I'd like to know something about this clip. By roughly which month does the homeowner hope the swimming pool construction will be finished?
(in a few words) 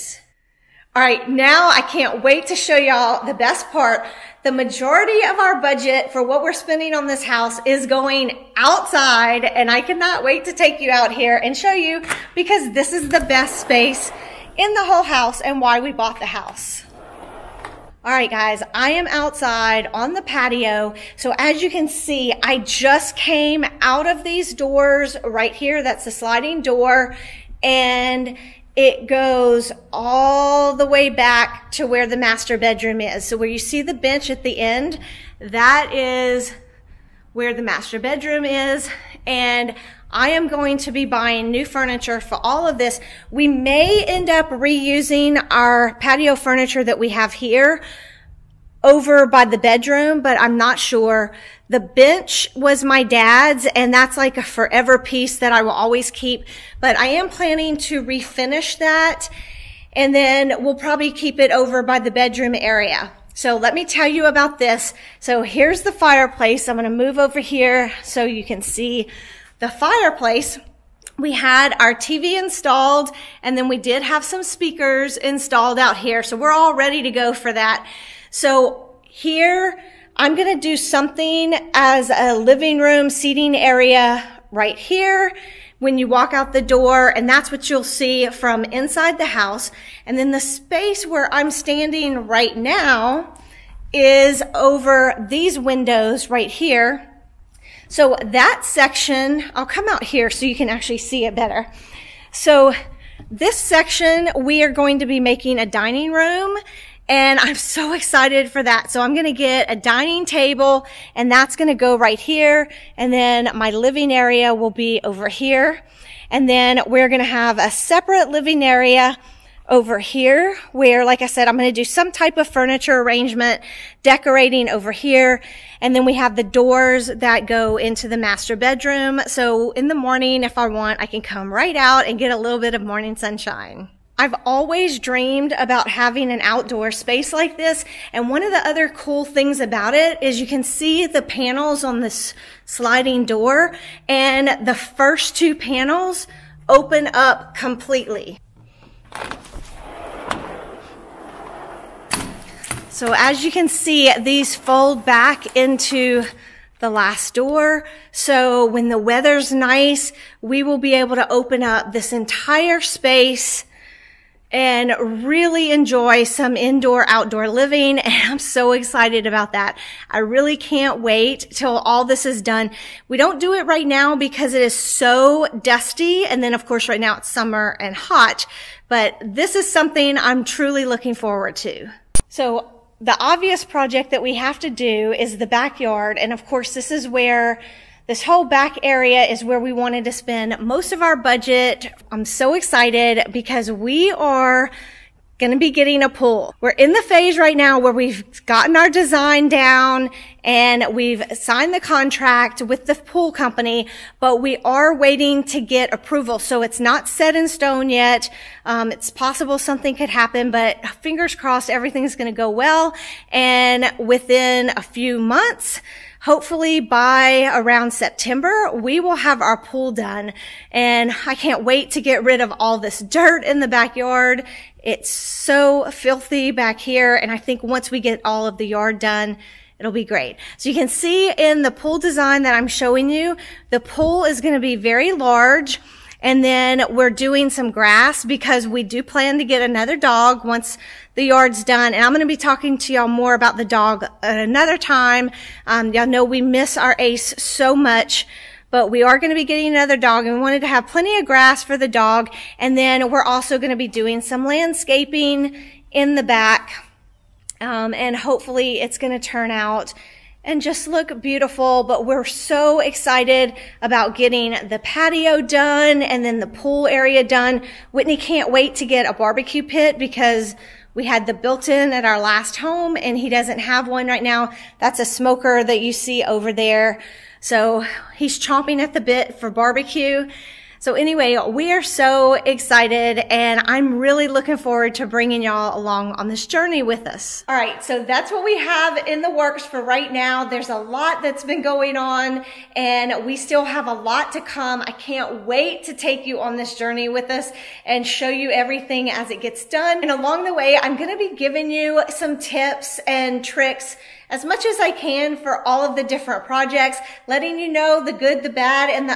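September.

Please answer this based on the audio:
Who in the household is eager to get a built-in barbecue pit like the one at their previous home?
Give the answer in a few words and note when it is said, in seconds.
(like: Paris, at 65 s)
Whitney, at 267 s.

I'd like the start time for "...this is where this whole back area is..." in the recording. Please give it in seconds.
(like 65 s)
186 s.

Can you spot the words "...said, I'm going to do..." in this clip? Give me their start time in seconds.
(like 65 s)
121 s.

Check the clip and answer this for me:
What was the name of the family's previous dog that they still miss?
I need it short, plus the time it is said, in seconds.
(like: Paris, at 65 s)
Ace, at 246 s.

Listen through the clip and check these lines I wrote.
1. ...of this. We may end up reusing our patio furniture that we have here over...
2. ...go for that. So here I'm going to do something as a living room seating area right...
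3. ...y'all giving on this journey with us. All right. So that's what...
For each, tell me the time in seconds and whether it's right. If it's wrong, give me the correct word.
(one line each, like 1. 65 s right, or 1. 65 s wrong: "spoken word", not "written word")
1. 42 s right
2. 77 s right
3. 285 s wrong: "along", not "giving".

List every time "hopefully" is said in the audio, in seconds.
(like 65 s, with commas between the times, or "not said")
216 s, 258 s.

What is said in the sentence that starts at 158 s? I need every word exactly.
So when the weather's nice, we will be able to open up this entire space and really enjoy some indoor outdoor living.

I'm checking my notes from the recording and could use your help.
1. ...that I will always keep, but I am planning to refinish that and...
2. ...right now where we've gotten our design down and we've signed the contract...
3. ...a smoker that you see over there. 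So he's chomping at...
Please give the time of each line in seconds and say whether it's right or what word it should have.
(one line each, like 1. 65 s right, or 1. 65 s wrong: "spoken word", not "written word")
1. 55 s right
2. 197 s right
3. 275 s right.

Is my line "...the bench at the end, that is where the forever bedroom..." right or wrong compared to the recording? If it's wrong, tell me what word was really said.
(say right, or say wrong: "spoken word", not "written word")
wrong: "master", not "forever".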